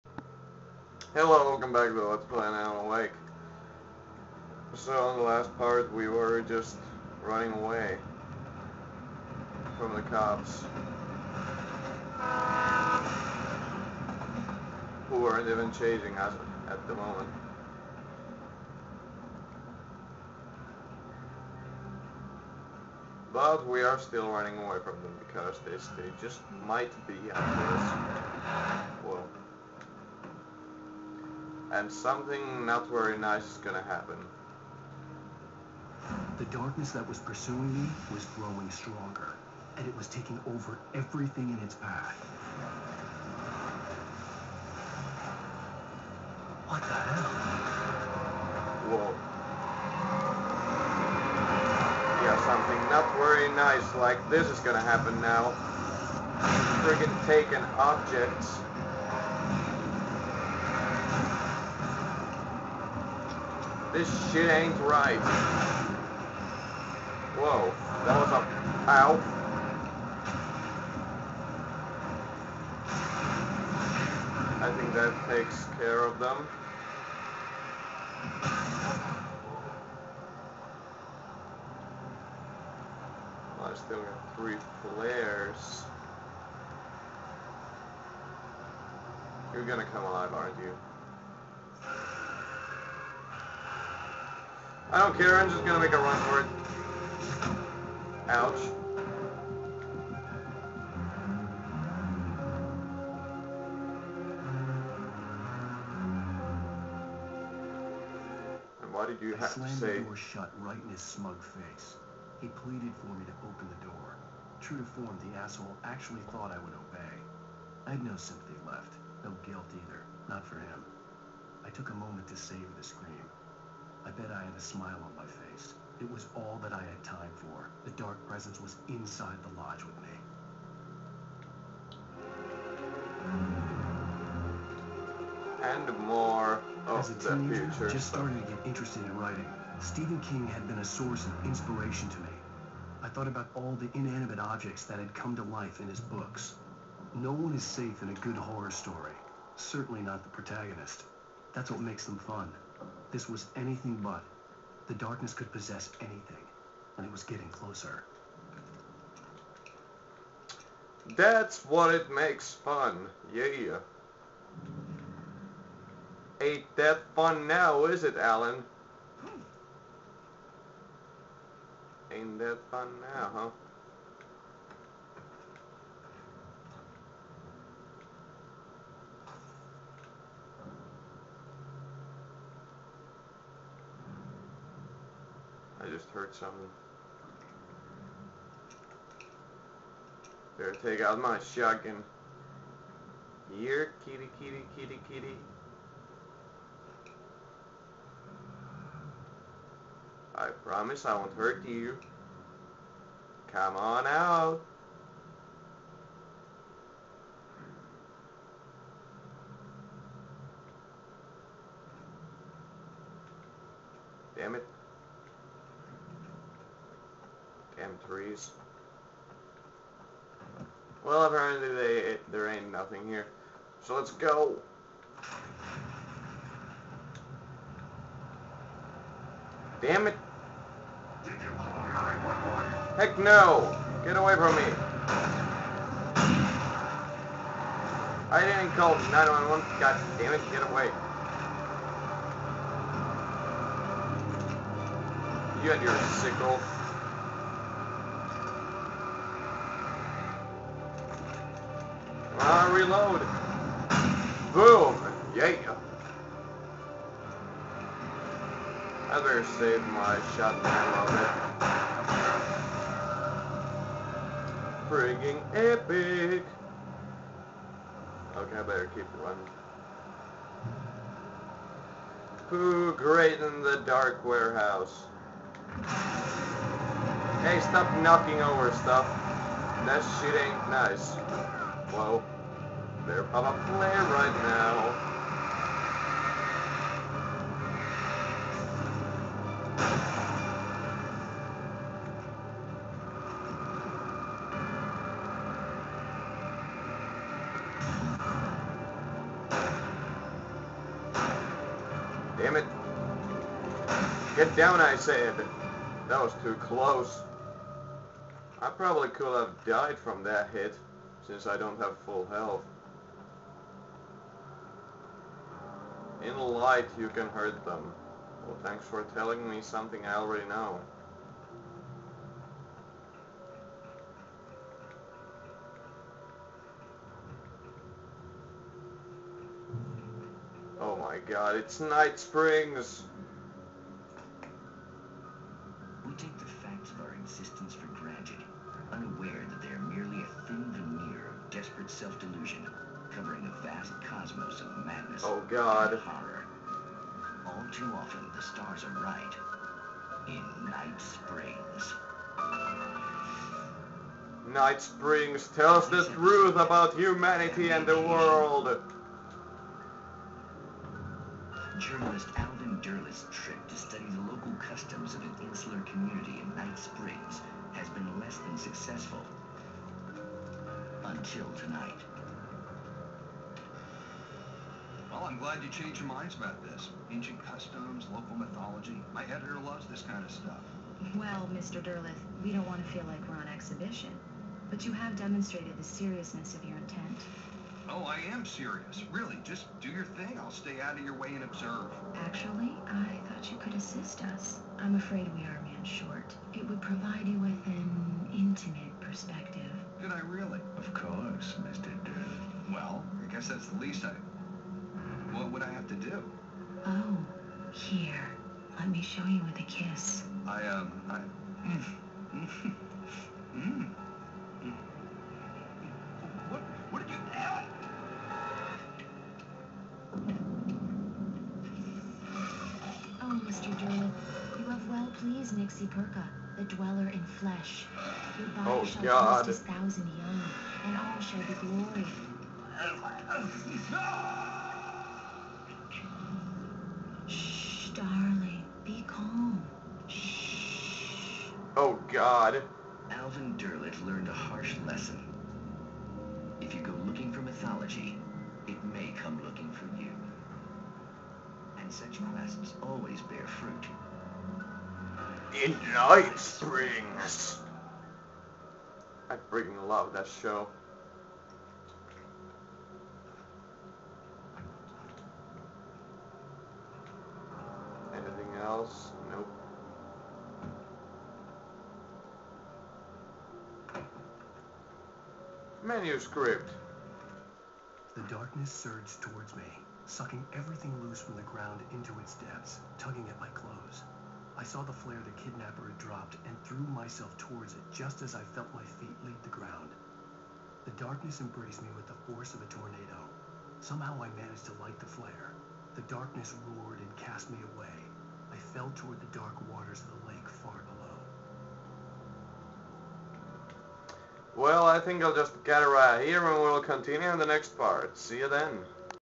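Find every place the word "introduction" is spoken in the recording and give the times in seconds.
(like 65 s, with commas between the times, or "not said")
not said.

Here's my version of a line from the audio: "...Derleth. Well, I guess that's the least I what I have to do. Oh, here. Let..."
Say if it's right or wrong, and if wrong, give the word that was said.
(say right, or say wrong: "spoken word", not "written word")
right.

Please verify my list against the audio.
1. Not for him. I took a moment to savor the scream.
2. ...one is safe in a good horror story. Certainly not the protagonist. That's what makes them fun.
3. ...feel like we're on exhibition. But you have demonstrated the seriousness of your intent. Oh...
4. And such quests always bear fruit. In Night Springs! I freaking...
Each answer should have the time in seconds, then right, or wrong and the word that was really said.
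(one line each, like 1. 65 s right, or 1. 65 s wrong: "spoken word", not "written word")
1. 120 s right
2. 147 s right
3. 382 s right
4. 451 s right.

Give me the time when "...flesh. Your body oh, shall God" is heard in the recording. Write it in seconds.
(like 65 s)
427 s.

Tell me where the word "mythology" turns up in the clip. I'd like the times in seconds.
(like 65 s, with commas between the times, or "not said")
378 s, 447 s.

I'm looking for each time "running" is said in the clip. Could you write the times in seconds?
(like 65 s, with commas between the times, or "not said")
7 s, 24 s, 269 s.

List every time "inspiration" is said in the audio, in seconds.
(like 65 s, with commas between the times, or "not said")
141 s.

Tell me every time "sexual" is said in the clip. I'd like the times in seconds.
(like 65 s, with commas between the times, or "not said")
not said.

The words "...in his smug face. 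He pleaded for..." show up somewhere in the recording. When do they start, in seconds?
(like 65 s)
110 s.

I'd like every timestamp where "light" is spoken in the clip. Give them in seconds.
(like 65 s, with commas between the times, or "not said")
316 s, 494 s.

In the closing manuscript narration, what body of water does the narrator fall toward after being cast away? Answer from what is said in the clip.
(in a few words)
The lake.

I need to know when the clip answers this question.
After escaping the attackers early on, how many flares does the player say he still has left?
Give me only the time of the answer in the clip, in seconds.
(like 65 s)
84 s.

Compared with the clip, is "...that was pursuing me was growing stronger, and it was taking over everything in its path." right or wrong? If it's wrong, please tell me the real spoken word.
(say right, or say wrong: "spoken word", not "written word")
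right.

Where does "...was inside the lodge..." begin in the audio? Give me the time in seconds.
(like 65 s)
128 s.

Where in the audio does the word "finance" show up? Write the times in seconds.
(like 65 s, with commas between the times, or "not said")
not said.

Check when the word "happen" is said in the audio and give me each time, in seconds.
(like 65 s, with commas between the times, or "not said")
33 s, 54 s.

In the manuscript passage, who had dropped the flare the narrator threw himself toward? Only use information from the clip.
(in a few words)
The kidnapper.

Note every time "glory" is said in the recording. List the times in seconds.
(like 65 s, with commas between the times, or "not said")
431 s.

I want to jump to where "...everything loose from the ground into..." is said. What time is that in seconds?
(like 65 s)
480 s.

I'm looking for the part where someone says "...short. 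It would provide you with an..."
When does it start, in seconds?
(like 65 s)
395 s.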